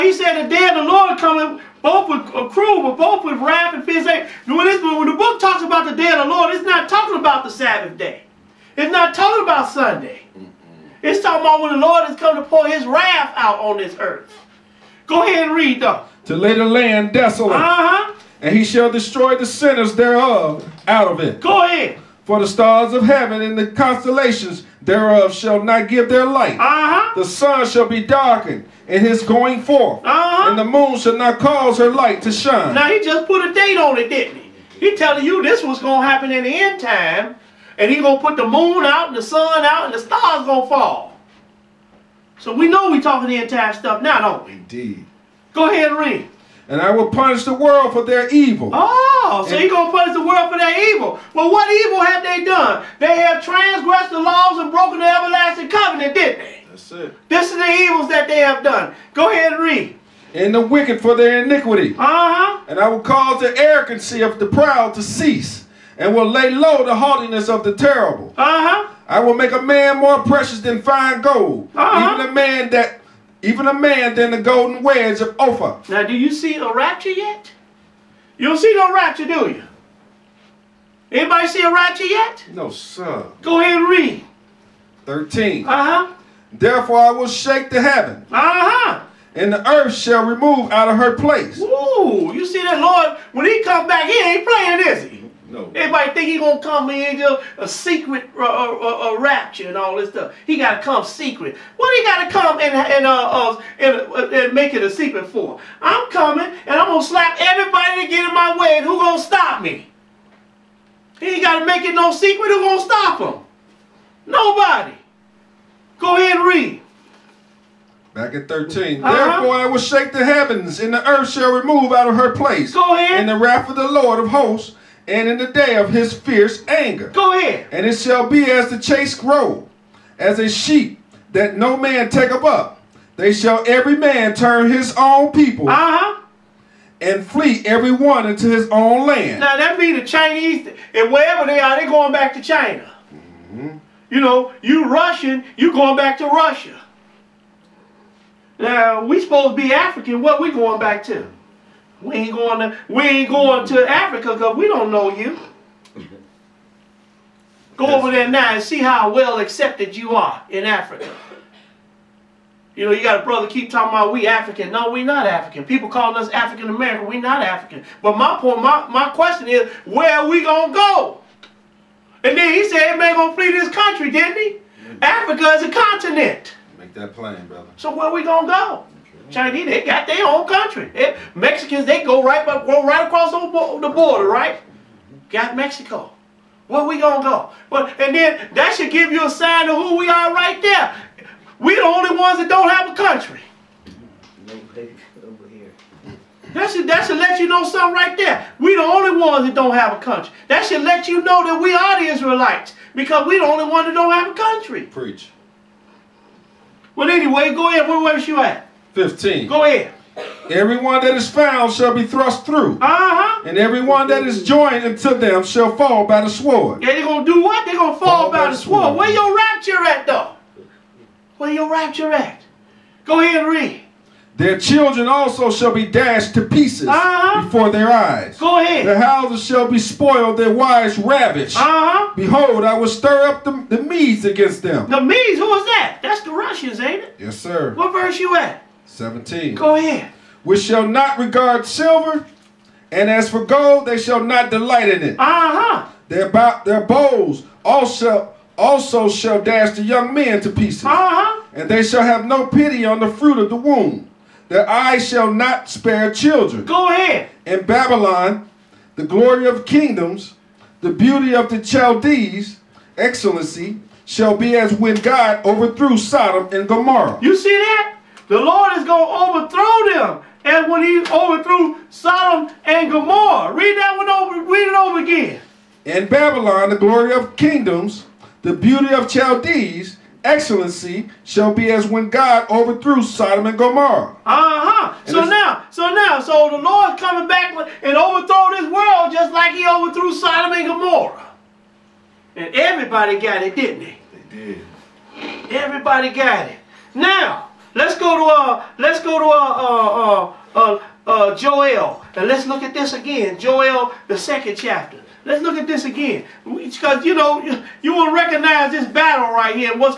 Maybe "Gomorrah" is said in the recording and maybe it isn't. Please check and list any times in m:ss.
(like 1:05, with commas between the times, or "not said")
4:26, 4:32, 4:43, 4:50.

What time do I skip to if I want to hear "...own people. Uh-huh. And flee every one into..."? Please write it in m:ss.
2:14.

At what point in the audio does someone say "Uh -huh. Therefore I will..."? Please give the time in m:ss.
1:59.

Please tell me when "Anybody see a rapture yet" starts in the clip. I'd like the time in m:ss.
1:21.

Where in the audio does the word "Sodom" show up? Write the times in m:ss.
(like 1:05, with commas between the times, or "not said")
4:25, 4:31, 4:43, 4:50.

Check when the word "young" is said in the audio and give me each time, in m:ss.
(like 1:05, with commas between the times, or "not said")
4:09.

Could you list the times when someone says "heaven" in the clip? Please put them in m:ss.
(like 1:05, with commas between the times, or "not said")
0:23, 1:27, 2:00.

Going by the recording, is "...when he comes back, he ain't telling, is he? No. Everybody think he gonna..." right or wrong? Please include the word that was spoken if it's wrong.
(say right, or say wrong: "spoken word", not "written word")
wrong: "playing", not "telling".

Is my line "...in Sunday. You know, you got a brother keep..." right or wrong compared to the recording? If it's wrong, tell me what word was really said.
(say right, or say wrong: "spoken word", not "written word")
wrong: "Africa", not "Sunday".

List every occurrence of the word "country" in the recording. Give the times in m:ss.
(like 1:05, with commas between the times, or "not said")
2:53, 3:00, 3:12, 3:19, 3:24.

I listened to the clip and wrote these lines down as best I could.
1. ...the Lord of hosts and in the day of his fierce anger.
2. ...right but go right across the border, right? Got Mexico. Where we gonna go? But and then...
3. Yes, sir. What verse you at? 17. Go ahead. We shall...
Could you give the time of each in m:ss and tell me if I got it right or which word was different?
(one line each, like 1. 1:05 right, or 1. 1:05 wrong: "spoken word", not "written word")
1. 2:03 right
2. 3:02 right
3. 3:57 right.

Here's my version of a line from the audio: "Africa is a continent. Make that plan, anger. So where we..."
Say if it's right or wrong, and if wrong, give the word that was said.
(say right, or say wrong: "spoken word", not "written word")
wrong: "brother", not "anger".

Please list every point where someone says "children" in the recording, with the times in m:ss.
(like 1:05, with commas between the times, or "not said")
3:44, 4:16.